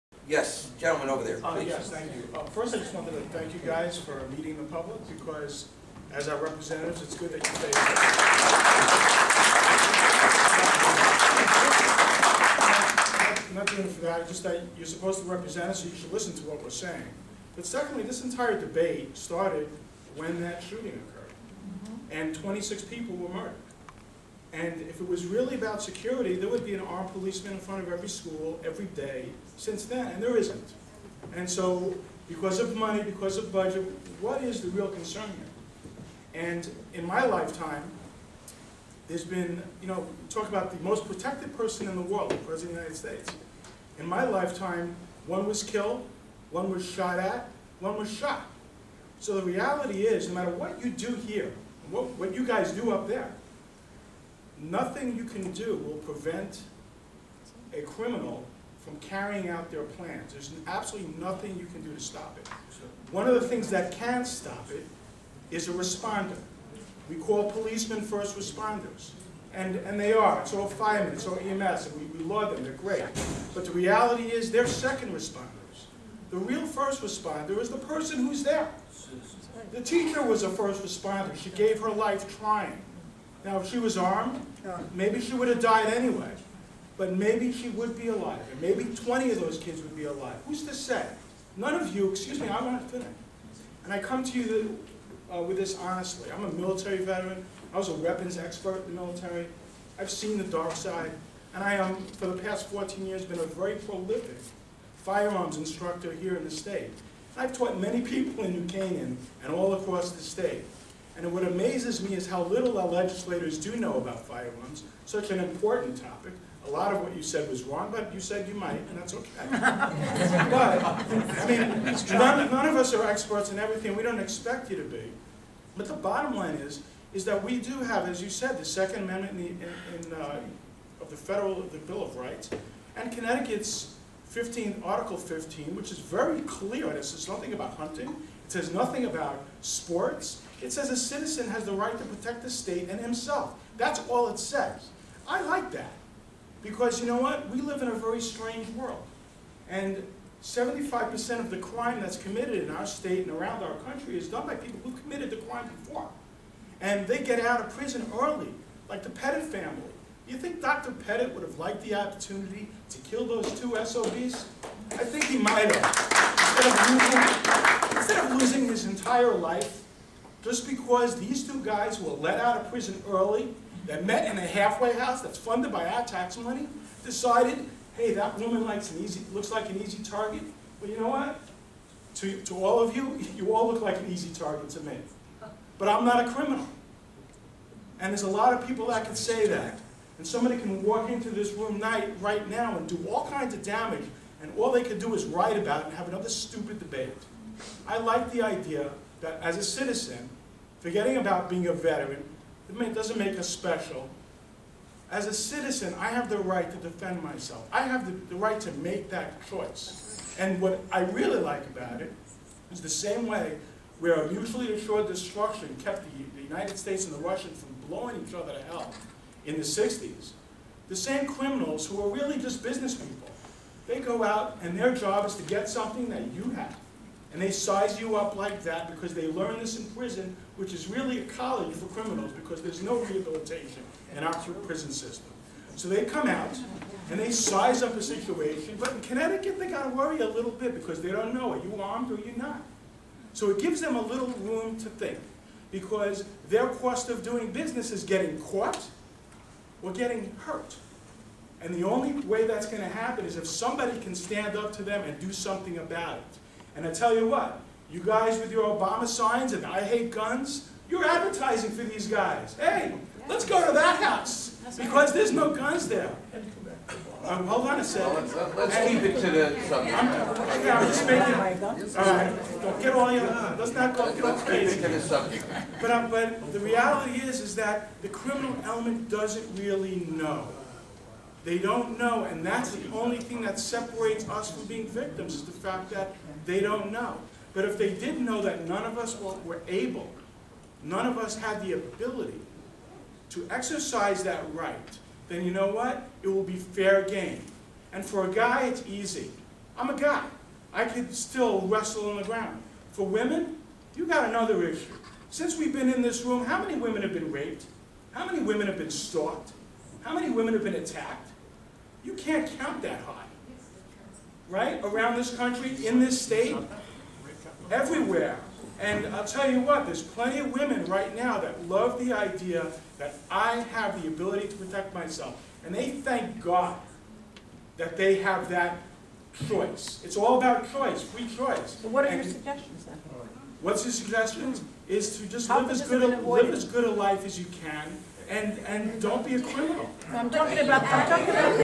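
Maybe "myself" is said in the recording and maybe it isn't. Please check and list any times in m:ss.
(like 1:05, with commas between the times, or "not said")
3:27, 5:24.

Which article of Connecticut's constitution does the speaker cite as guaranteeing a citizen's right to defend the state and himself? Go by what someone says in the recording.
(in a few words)
Article 15.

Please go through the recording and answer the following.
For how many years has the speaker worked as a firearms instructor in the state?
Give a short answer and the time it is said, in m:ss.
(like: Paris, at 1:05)
14, at 1:42.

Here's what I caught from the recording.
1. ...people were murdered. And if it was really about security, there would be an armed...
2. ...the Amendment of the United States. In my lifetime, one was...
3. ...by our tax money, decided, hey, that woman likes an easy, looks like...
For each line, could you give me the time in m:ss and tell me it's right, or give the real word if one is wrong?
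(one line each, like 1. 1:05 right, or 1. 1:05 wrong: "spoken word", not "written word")
1. 0:22 right
2. 0:42 wrong: "President", not "Amendment"
3. 2:55 right.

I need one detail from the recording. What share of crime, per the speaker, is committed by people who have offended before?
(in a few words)
75%.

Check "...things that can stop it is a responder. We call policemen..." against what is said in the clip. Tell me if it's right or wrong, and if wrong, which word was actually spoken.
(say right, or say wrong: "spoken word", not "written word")
right.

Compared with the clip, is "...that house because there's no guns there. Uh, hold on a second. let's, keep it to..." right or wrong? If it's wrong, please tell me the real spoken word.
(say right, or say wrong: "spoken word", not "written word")
right.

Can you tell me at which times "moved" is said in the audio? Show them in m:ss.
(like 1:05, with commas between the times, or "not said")
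not said.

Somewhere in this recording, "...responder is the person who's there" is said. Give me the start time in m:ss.
1:17.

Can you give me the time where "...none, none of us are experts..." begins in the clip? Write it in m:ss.
2:02.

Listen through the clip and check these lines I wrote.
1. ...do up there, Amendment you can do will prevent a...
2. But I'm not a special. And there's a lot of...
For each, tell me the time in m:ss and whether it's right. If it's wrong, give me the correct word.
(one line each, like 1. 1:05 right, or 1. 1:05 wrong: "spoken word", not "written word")
1. 0:52 wrong: "Nothing", not "Amendment"
2. 3:05 wrong: "criminal", not "special".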